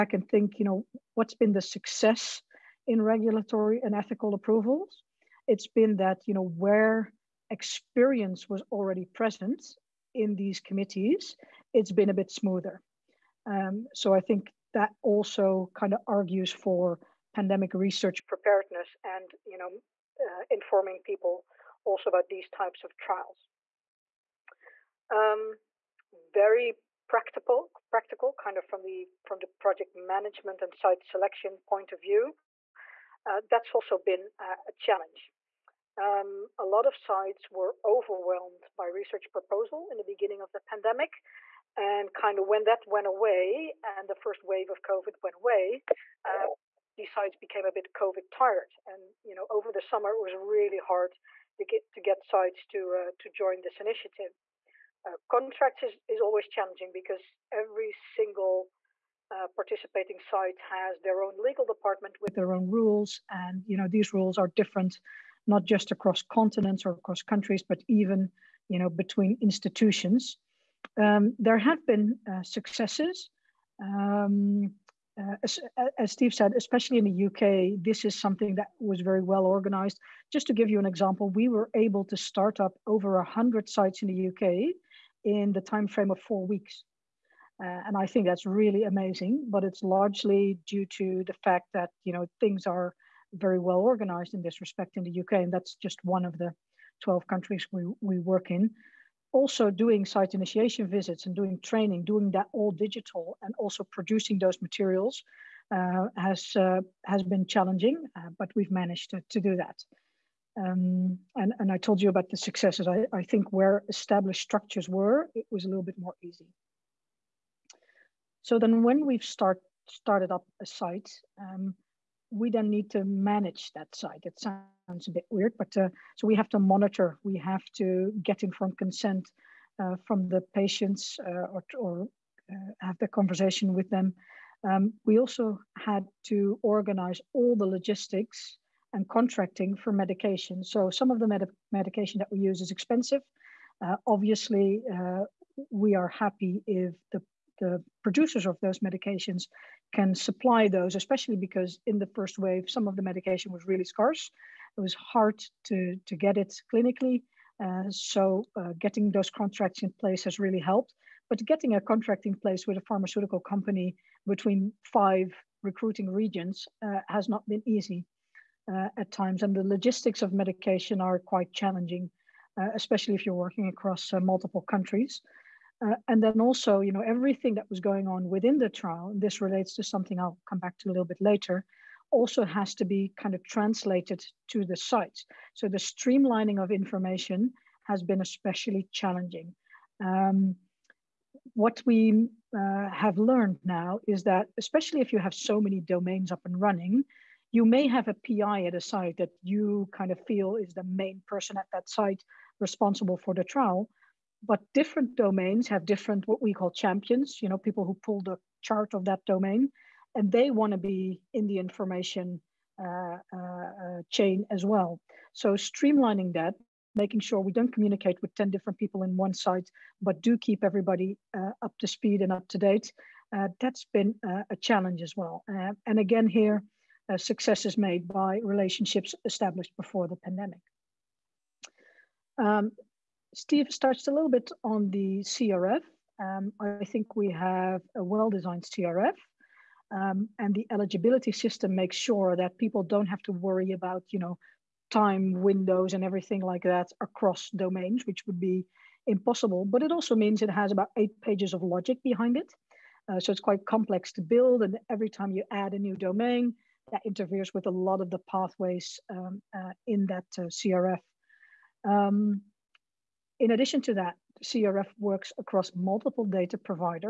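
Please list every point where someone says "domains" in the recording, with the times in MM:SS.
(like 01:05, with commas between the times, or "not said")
03:15, 03:25, 03:29, 04:07, 04:15.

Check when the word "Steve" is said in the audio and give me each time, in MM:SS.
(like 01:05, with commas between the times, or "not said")
01:16, 03:53.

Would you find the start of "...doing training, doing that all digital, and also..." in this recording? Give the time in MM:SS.
01:41.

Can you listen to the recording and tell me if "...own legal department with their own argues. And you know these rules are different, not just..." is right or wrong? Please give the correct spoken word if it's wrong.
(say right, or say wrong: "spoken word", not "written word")
wrong: "rules", not "argues".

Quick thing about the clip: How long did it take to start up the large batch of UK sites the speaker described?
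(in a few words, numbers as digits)
4 weeks.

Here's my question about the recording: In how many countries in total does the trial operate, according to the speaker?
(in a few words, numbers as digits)
12.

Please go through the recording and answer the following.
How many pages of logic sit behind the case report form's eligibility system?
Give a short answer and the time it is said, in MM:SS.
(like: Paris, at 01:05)
about 8 pages, at 04:10.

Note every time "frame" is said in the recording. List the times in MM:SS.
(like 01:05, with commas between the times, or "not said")
01:25.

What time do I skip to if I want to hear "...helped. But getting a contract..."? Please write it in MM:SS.
02:40.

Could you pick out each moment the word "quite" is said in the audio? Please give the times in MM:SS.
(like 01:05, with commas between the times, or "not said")
02:51, 04:13.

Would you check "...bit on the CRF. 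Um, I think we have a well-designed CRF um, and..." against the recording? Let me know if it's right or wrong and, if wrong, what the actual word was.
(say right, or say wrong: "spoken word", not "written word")
right.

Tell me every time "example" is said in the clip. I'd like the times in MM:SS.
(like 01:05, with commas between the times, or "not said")
01:20.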